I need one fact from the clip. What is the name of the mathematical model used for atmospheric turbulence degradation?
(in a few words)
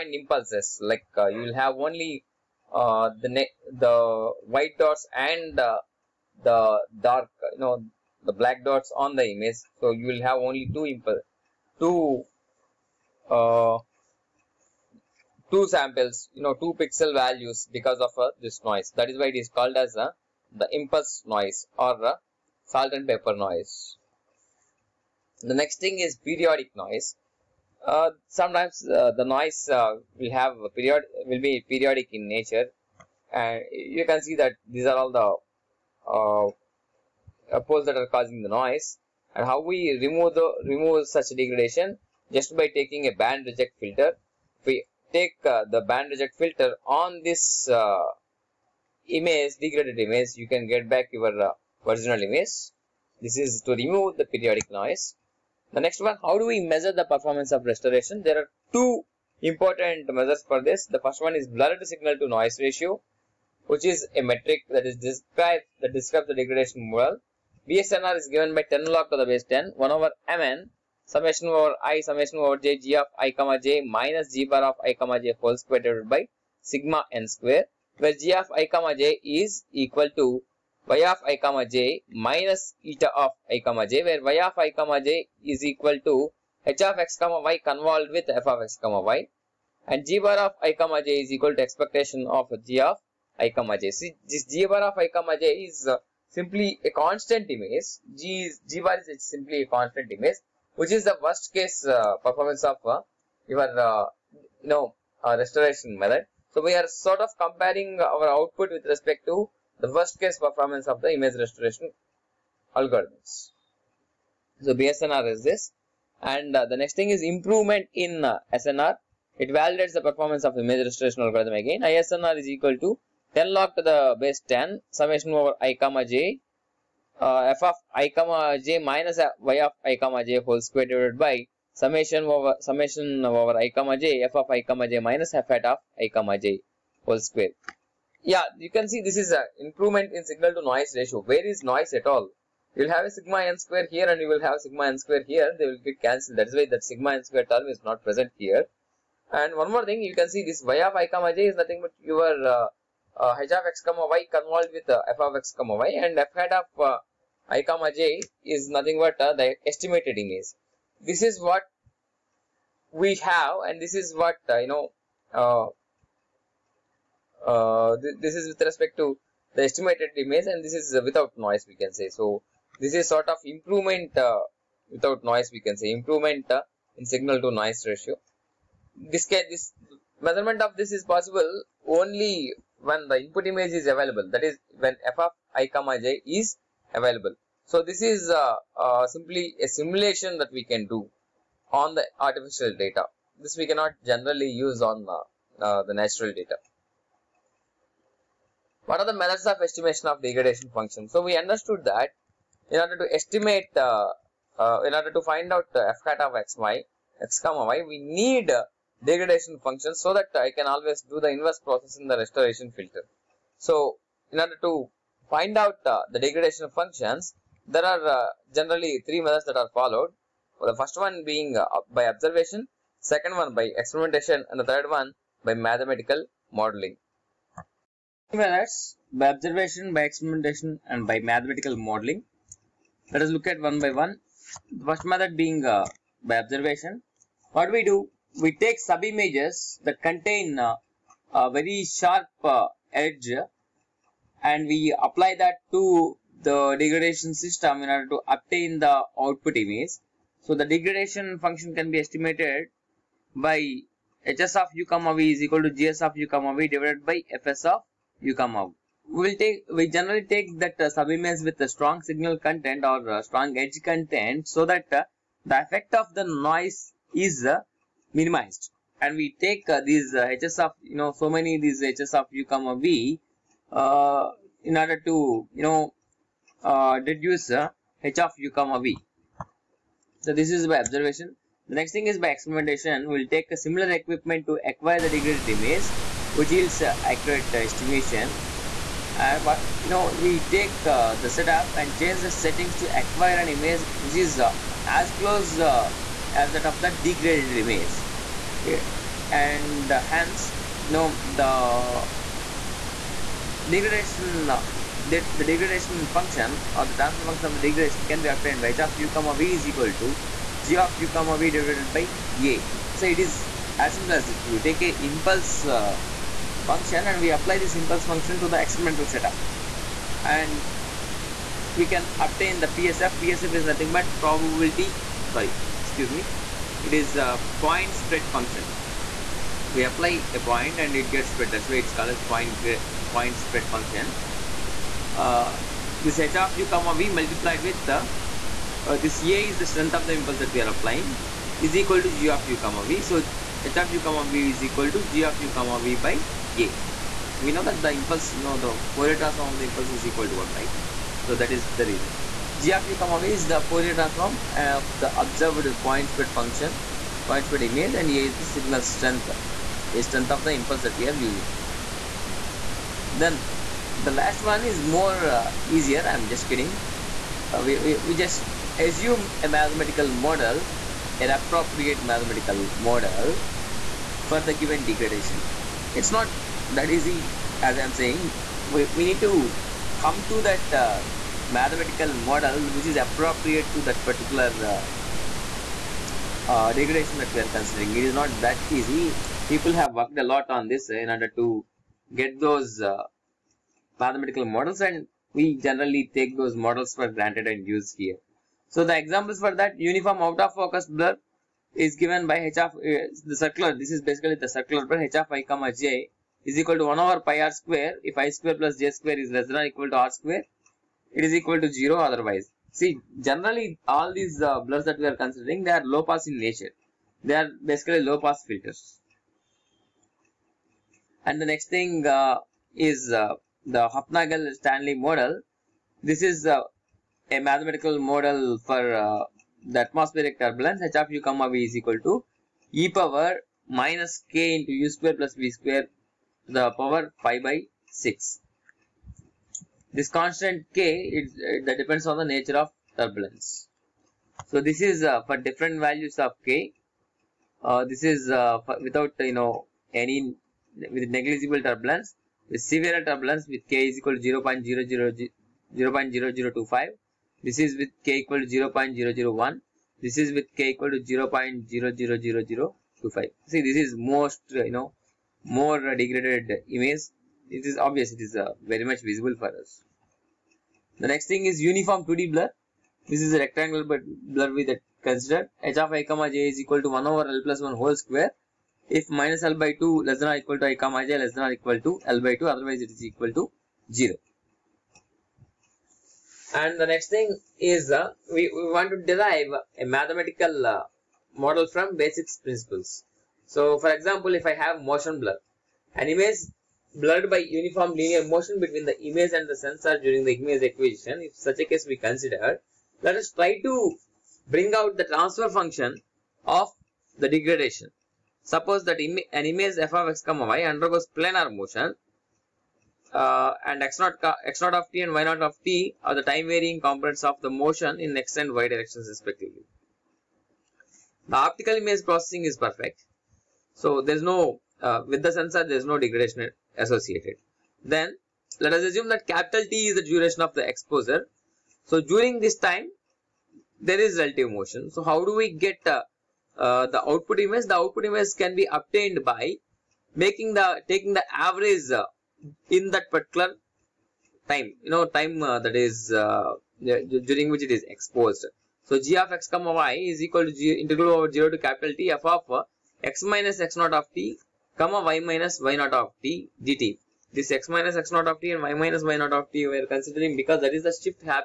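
Hufnagel Stanley model.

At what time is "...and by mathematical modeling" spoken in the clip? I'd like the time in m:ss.
3:50.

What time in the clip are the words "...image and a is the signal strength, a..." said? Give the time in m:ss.
5:57.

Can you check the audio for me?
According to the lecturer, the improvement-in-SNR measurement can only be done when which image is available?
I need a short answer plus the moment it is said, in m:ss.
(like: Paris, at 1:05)
The input image, at 3:03.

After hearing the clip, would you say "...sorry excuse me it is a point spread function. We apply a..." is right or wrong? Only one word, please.
right.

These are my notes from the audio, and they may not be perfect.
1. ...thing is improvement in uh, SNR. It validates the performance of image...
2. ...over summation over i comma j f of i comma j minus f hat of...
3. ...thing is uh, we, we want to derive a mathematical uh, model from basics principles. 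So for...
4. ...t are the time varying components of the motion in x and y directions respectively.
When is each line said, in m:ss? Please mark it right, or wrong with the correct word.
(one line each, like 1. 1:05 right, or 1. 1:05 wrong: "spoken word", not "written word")
1. 1:56 right
2. 2:12 right
3. 8:07 right
4. 8:35 right.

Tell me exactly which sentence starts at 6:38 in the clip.
So the examples for that uniform out of focus blur is given by h of uh, the circular.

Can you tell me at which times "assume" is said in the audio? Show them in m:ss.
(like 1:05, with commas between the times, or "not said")
6:08, 8:48.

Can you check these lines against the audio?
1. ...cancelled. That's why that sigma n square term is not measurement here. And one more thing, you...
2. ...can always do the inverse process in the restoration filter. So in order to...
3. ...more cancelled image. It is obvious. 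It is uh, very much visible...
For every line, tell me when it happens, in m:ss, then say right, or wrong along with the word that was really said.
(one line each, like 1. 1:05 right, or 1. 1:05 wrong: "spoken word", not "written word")
1. 2:26 wrong: "present", not "measurement"
2. 3:30 right
3. 7:45 wrong: "degraded", not "cancelled".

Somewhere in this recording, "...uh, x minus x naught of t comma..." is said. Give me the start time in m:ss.
9:12.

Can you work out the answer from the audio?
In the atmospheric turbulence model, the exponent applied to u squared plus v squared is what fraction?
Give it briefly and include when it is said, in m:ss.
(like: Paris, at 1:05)
Pi by 6, at 7:17.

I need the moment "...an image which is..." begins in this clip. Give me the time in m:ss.
4:53.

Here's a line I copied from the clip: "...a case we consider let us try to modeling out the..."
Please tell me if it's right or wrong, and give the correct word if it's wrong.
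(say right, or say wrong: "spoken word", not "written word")
wrong: "bring", not "modeling".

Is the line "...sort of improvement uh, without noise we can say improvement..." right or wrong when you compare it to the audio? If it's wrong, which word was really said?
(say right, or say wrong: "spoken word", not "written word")
right.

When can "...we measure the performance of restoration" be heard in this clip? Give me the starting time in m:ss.
0:56.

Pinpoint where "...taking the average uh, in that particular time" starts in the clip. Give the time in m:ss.
9:00.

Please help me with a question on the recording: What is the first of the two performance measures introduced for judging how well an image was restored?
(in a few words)
Blurred signal to noise ratio.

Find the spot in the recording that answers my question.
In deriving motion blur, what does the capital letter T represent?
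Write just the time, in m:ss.
8:50.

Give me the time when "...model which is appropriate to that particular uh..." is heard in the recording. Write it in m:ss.
6:22.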